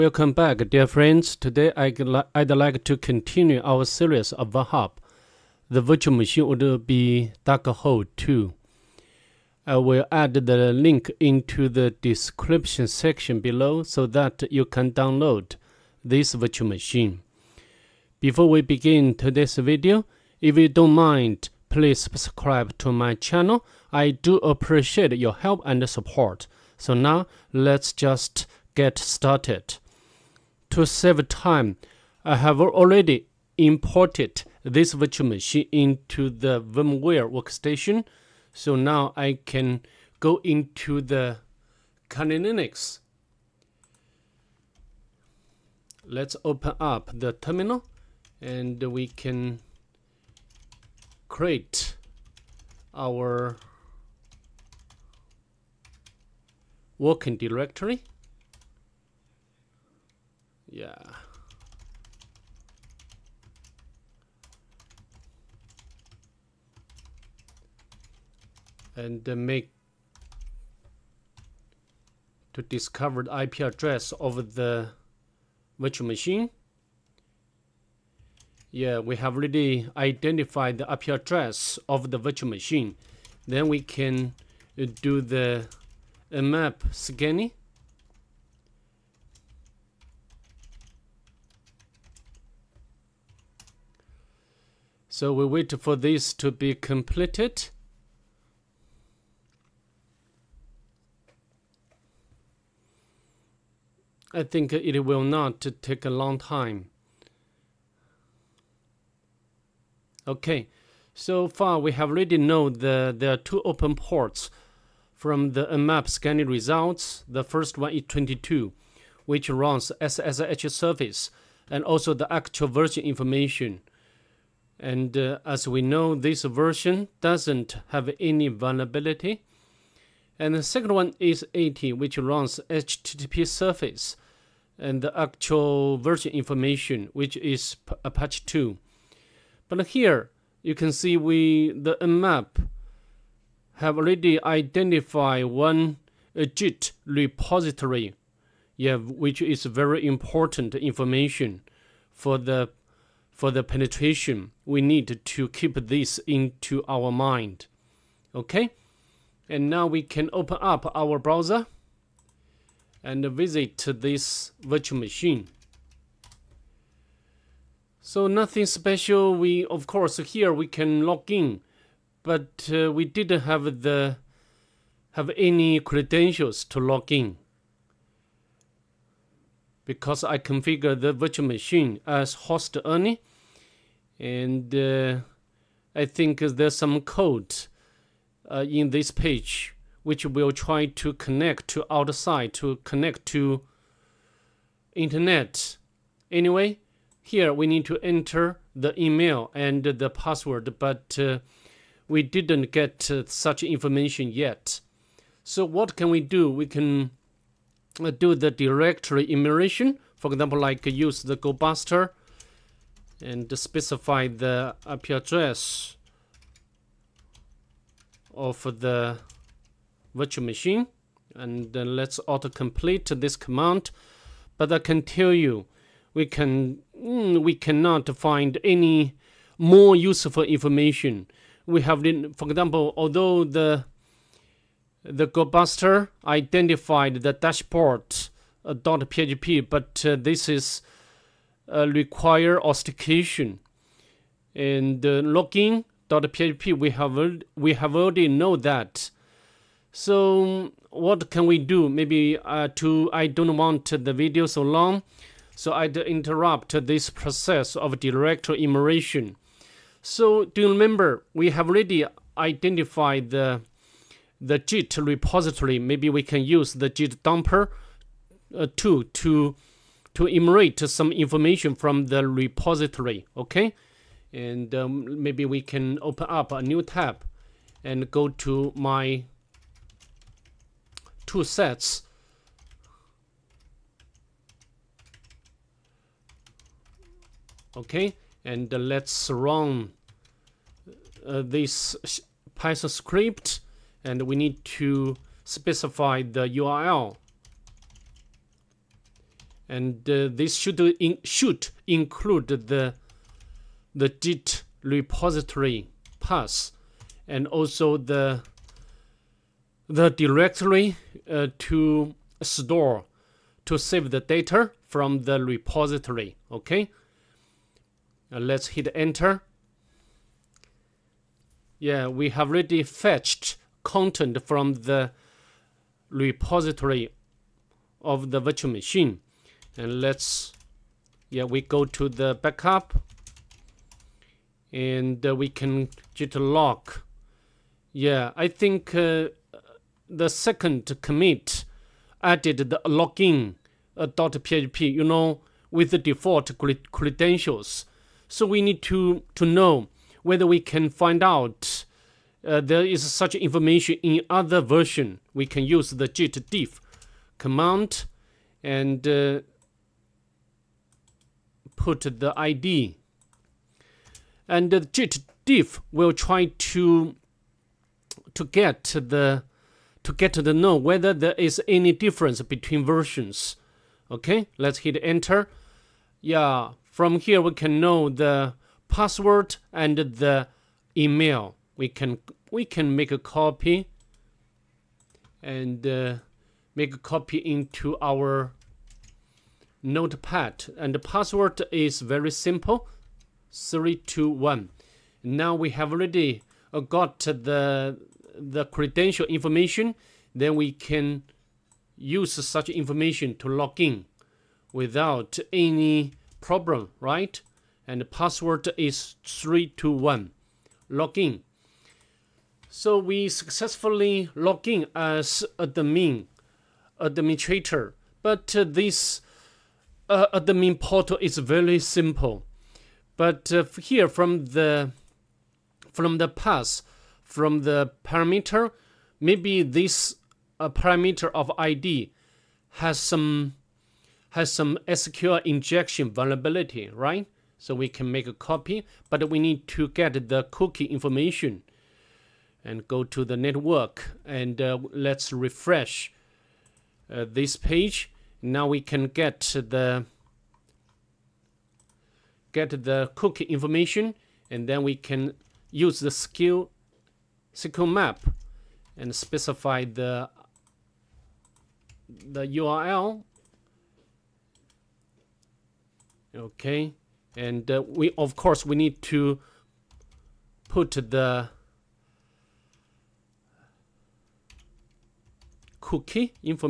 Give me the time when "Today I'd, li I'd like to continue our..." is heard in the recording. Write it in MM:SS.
00:01.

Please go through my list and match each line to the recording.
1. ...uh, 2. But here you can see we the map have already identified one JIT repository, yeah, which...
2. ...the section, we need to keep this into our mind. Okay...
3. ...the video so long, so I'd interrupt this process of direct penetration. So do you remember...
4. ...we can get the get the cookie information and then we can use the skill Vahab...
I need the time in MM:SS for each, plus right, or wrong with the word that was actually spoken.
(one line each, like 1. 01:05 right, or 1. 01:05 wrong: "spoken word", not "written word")
1. 02:18 right
2. 02:33 wrong: "penetration", not "section"
3. 04:13 wrong: "immersion", not "penetration"
4. 07:28 wrong: "SQL", not "Vahab".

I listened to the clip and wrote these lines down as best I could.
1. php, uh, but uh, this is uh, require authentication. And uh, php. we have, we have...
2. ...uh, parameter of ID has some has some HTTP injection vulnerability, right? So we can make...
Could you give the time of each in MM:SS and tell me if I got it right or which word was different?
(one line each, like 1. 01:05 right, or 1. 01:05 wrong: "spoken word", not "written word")
1. 03:58 right
2. 07:10 wrong: "SQL", not "HTTP".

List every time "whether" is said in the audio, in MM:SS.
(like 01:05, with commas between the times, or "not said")
05:50, 06:10.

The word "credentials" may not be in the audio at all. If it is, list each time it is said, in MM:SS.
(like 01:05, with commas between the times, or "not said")
02:55, 05:46, 06:38.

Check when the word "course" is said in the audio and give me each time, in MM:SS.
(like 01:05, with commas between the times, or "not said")
02:49, 07:48.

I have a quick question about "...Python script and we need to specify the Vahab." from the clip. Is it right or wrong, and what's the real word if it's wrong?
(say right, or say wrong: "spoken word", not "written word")
wrong: "URL", not "Vahab".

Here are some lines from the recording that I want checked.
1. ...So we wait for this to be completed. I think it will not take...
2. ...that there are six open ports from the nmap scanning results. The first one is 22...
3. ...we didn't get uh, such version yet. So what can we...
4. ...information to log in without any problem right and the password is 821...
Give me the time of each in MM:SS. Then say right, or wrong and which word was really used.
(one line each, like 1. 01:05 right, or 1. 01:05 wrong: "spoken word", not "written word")
1. 01:35 right
2. 01:52 wrong: "two", not "six"
3. 03:22 wrong: "information", not "version"
4. 06:42 wrong: "321", not "821".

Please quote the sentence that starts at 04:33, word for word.
Okay, and um, maybe we can open up a new tab and go to my two sets.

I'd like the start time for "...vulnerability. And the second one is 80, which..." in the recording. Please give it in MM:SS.
02:08.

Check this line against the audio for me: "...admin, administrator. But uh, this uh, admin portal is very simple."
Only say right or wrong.
right.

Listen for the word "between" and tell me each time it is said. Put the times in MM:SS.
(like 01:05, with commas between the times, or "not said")
06:12.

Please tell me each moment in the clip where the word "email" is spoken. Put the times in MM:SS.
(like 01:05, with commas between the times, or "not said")
03:19, 06:20.